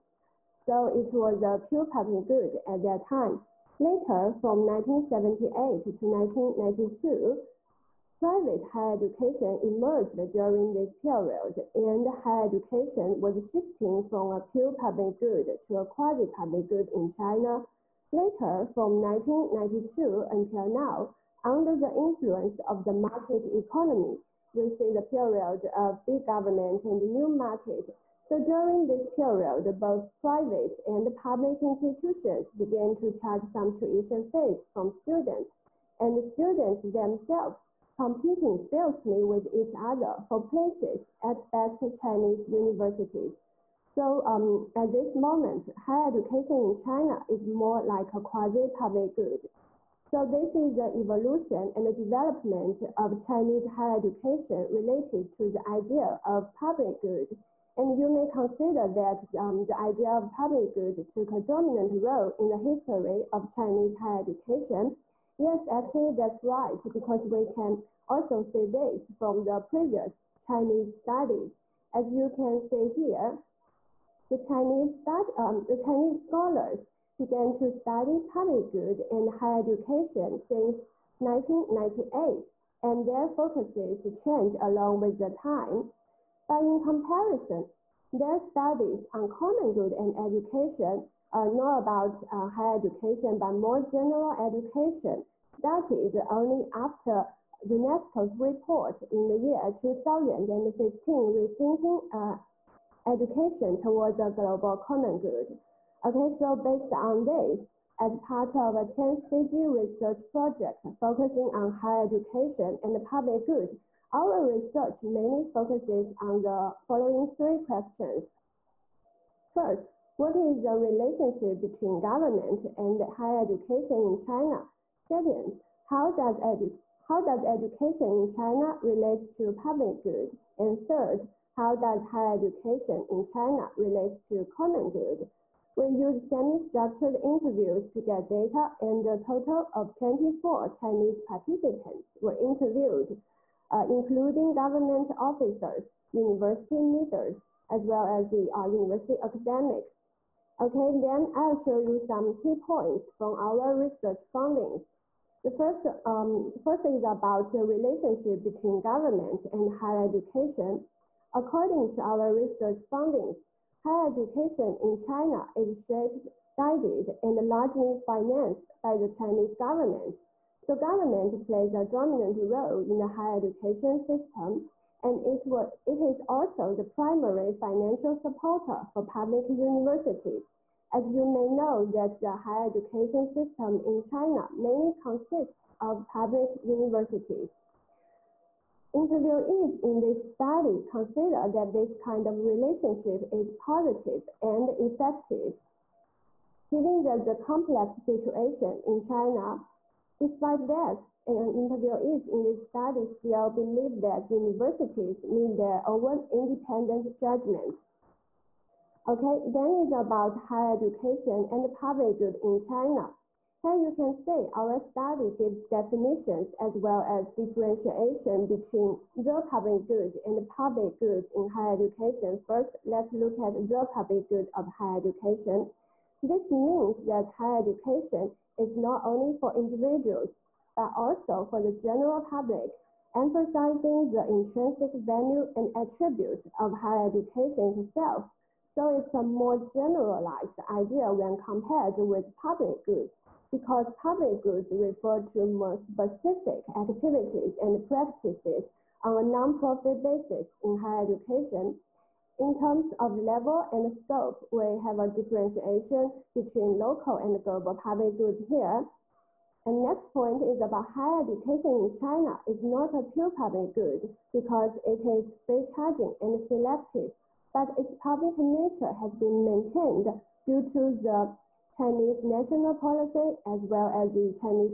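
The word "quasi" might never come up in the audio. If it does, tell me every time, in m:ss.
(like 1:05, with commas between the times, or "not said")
0:15, 0:48.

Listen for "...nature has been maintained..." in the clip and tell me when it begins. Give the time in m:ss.
4:28.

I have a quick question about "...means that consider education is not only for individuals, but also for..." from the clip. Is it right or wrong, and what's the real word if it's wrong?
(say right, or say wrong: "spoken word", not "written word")
wrong: "higher", not "consider".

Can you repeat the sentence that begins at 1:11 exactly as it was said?
As you can see here, the Chinese, study.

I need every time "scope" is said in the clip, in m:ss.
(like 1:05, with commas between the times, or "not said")
4:13.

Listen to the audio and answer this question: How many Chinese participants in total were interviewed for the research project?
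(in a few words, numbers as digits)
24.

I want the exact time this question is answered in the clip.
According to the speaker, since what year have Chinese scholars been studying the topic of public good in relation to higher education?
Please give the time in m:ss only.
1:21.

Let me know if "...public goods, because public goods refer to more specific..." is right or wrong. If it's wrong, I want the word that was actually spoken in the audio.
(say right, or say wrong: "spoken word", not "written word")
right.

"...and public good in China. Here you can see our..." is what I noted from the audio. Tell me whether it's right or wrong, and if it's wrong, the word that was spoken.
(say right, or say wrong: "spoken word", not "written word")
right.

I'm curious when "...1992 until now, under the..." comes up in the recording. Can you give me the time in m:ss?
0:19.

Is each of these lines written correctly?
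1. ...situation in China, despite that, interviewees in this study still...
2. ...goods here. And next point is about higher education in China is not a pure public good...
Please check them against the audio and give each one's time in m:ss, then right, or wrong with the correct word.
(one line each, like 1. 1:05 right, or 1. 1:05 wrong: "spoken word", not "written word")
1. 3:18 right
2. 4:18 right.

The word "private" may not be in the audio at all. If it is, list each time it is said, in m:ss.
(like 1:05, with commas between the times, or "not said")
0:08, 0:30.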